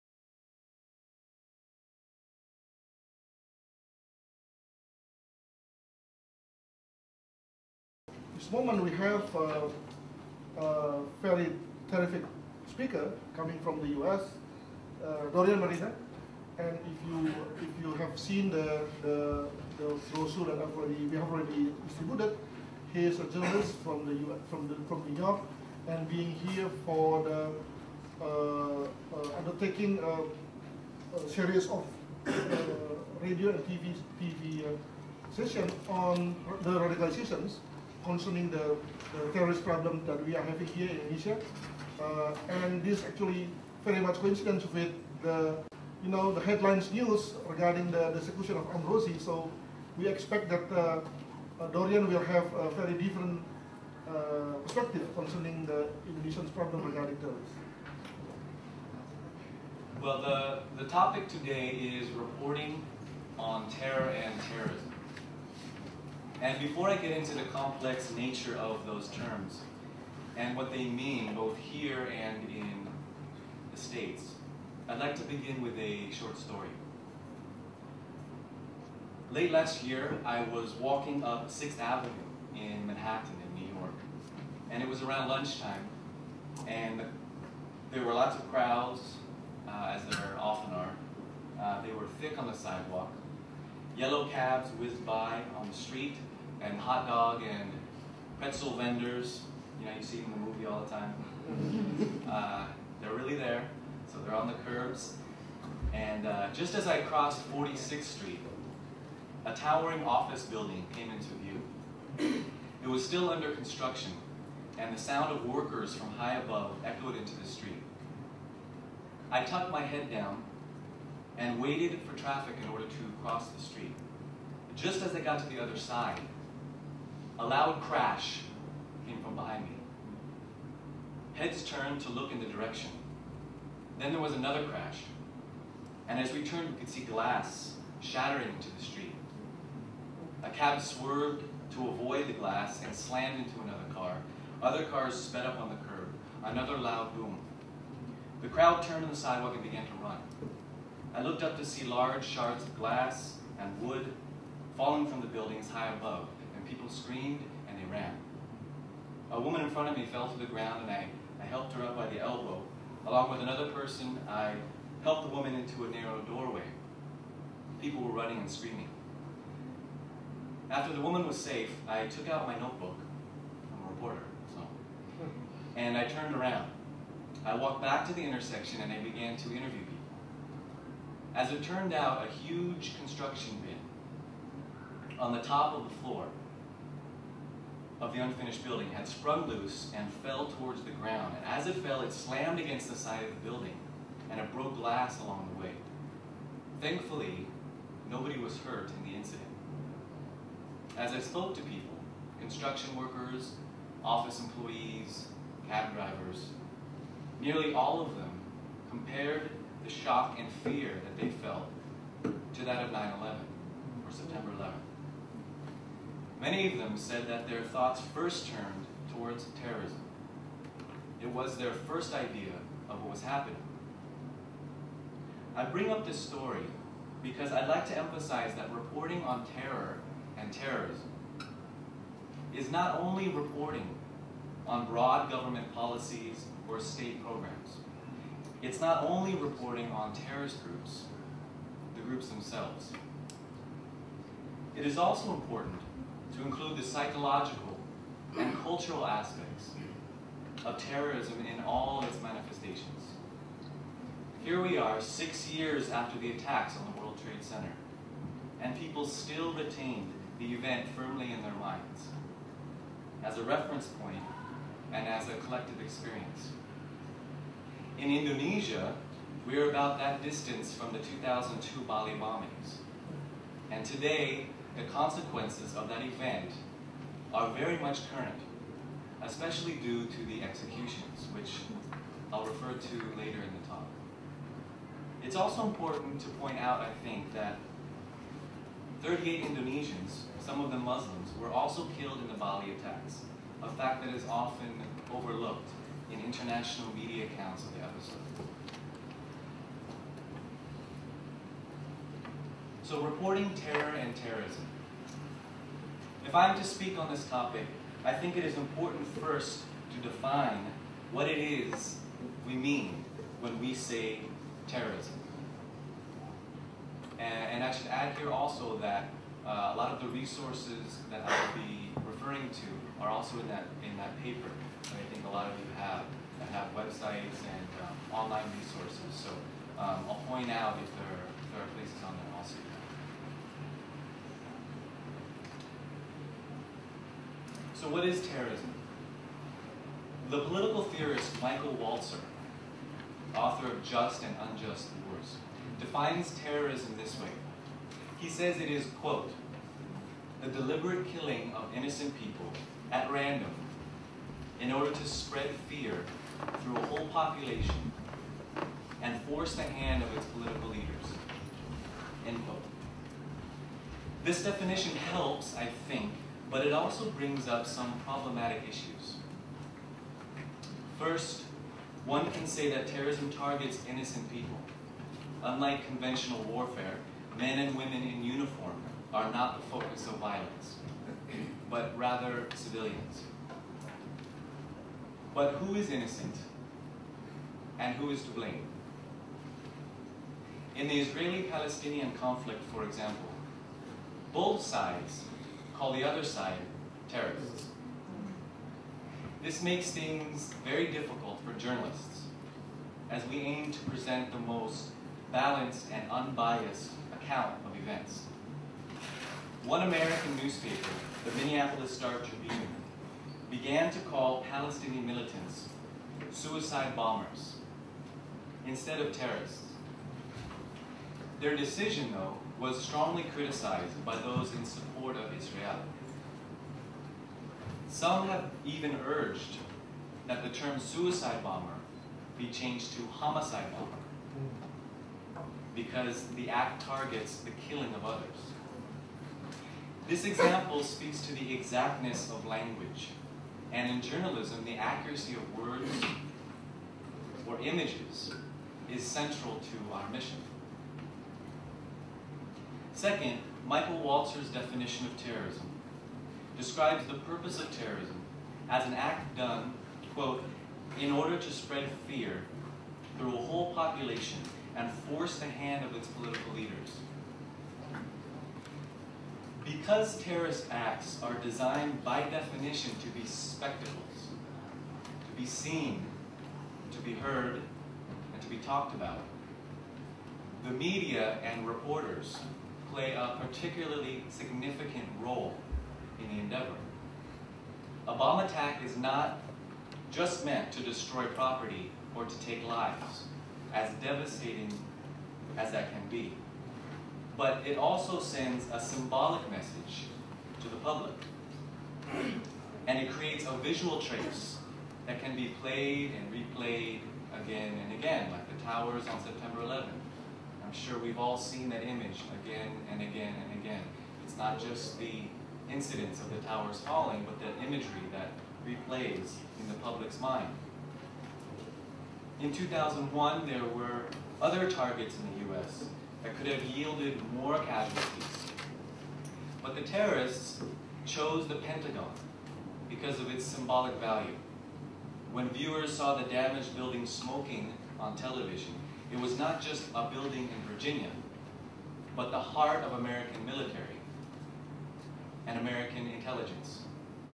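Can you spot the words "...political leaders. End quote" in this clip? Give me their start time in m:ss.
6:00.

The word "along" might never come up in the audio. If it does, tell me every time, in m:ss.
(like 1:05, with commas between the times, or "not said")
2:43, 3:15.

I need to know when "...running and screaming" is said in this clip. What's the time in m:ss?
2:48.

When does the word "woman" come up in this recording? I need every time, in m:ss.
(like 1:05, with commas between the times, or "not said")
2:39, 2:45, 2:51.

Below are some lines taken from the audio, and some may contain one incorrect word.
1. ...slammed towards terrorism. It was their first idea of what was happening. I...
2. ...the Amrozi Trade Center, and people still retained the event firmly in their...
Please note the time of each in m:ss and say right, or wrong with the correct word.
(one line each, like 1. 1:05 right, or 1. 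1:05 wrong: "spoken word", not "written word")
1. 3:38 wrong: "turned", not "slammed"
2. 4:16 wrong: "World", not "Amrozi".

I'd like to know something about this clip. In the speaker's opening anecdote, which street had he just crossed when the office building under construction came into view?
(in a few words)
46th Street.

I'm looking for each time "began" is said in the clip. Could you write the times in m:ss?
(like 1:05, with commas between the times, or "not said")
2:29, 2:58, 6:53.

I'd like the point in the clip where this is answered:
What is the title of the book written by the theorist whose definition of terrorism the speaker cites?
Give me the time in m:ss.
5:43.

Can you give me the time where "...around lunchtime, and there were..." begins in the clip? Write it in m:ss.
1:25.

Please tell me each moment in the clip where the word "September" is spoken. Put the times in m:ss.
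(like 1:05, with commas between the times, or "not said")
3:34, 8:29.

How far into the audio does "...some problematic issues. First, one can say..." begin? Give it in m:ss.
6:07.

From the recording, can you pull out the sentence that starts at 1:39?
You know, you see them in the movie all the time.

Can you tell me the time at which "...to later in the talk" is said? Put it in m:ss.
4:42.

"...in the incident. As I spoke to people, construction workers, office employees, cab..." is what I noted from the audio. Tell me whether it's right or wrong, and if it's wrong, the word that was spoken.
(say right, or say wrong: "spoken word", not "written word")
right.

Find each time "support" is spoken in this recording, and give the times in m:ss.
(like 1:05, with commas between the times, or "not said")
7:04.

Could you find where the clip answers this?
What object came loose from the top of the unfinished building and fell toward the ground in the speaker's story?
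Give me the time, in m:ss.
3:02.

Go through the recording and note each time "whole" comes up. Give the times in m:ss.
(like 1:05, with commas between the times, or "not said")
5:56, 7:43.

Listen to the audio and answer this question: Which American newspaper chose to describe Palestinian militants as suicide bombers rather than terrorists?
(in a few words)
Minneapolis Star Tribune.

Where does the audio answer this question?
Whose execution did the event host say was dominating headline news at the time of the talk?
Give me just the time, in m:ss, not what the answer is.
0:48.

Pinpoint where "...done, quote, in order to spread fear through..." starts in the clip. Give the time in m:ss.
7:39.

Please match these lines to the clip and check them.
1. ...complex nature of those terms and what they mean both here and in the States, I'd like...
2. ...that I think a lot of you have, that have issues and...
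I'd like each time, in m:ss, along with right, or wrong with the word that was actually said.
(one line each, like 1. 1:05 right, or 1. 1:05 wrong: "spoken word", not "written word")
1. 1:07 right
2. 5:24 wrong: "websites", not "issues".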